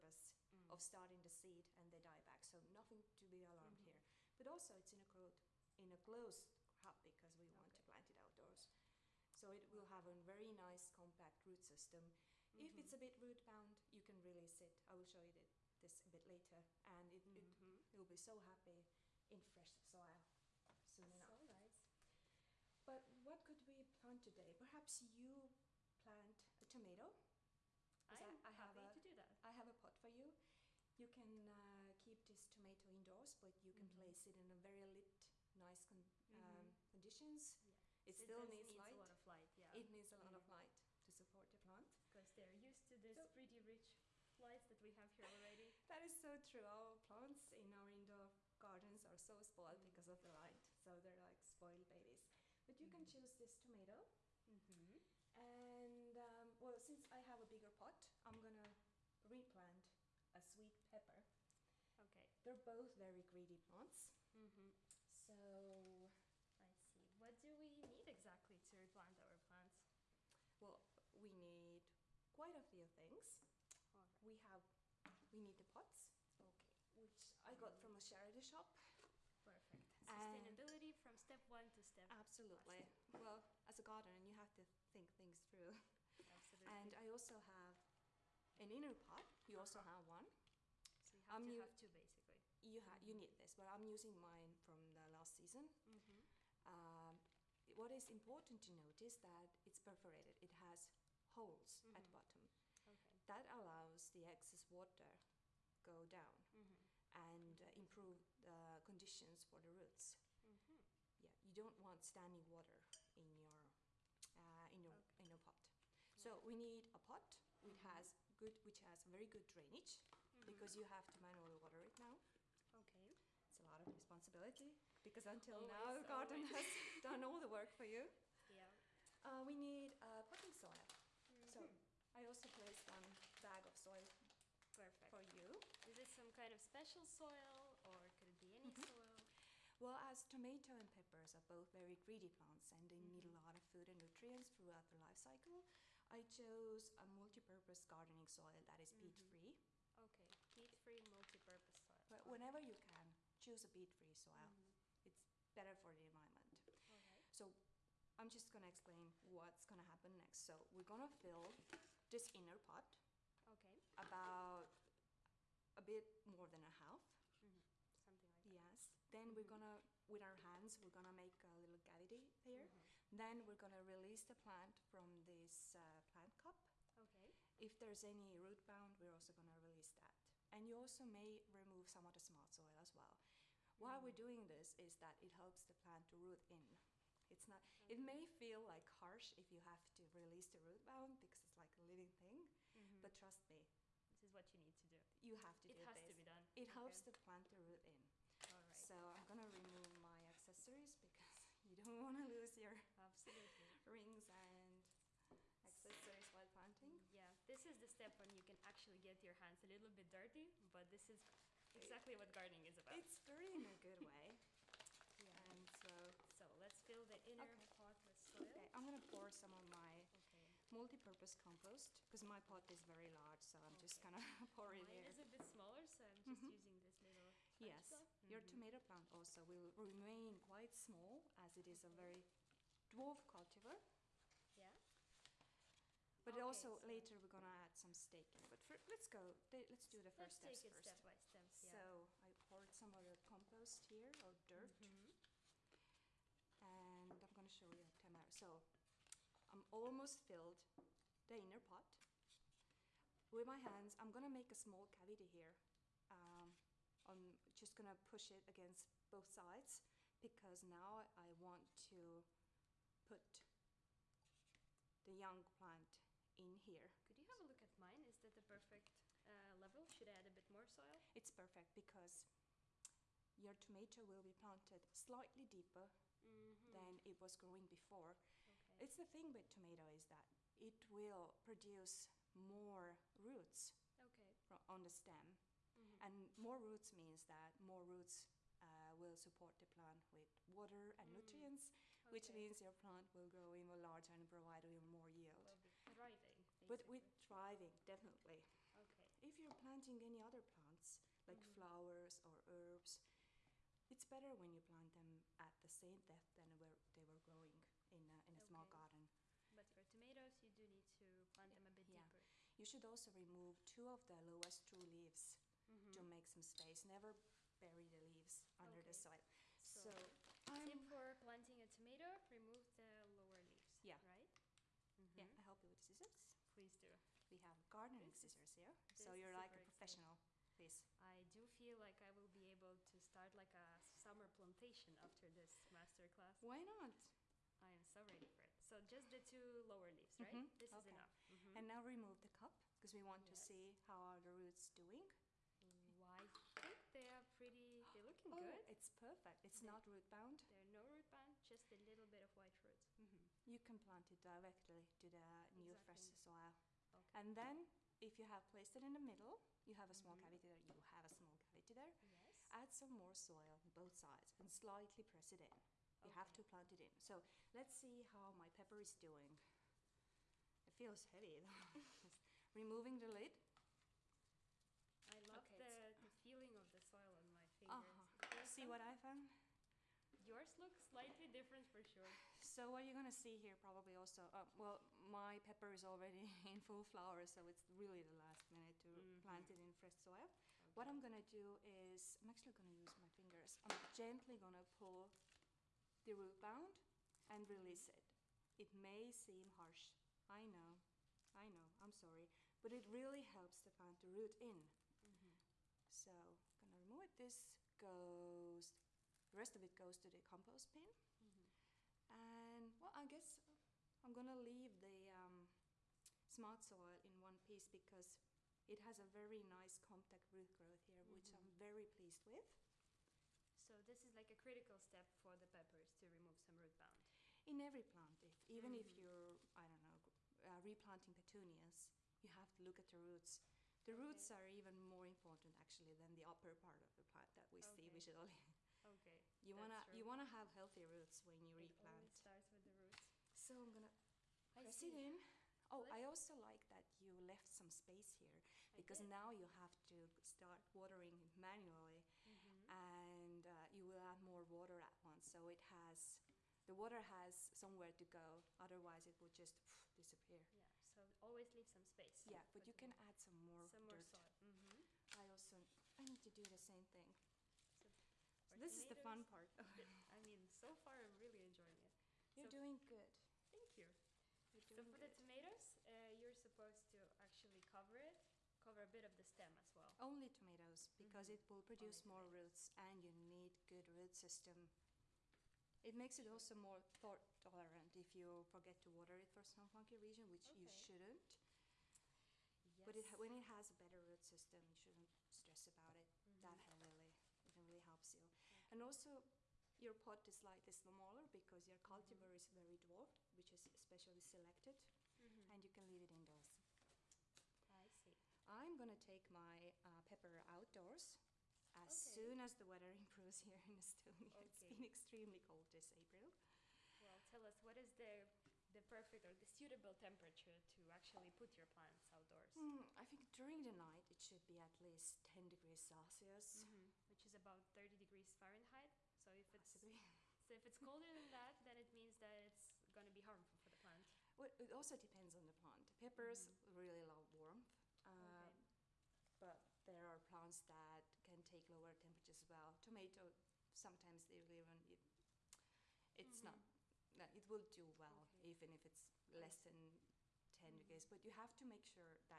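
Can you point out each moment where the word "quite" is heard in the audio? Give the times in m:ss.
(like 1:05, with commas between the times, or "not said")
1:12, 3:50.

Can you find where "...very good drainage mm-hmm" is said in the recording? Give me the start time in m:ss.
1:59.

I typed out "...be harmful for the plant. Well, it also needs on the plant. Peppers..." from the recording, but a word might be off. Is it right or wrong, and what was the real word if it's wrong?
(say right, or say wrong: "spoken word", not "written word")
wrong: "depends", not "needs".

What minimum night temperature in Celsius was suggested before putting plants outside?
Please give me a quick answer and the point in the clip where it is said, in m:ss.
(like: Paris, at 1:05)
10 degrees Celsius, at 8:45.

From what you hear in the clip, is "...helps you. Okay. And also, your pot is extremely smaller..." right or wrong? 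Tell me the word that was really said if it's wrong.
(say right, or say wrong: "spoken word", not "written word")
wrong: "slightly", not "extremely".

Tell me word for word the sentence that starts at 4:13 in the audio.
I'm gonna make a small cavity here.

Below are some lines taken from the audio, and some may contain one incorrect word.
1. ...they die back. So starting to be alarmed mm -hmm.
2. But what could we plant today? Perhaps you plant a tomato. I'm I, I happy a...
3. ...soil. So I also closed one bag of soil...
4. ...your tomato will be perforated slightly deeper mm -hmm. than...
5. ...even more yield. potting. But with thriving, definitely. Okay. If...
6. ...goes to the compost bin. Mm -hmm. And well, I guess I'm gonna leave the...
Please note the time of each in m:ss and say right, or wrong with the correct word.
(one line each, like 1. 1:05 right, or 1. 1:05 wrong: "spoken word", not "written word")
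1. 0:01 wrong: "nothing", not "starting"
2. 0:22 right
3. 2:10 wrong: "placed", not "closed"
4. 4:33 wrong: "planted", not "perforated"
5. 4:54 wrong: "thriving", not "potting"
6. 6:49 right.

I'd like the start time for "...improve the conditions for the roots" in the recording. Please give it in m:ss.
1:47.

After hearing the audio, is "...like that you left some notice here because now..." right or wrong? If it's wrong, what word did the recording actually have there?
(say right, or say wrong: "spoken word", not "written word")
wrong: "space", not "notice".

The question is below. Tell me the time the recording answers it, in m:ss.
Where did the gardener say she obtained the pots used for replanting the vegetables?
1:17.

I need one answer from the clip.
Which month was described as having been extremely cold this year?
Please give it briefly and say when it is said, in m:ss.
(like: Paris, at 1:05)
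April, at 8:35.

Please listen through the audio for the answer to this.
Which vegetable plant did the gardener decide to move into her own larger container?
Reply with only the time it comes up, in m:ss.
1:00.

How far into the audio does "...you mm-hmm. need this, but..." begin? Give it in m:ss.
1:32.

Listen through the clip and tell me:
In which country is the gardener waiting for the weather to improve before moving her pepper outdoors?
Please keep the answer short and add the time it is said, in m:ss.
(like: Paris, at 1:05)
Estonia, at 8:33.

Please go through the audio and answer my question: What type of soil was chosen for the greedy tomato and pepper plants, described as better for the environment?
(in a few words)
Peat-free multi-purpose soil.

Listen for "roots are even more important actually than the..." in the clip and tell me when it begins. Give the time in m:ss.
7:14.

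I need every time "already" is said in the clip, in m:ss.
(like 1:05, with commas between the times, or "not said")
0:45, 6:25.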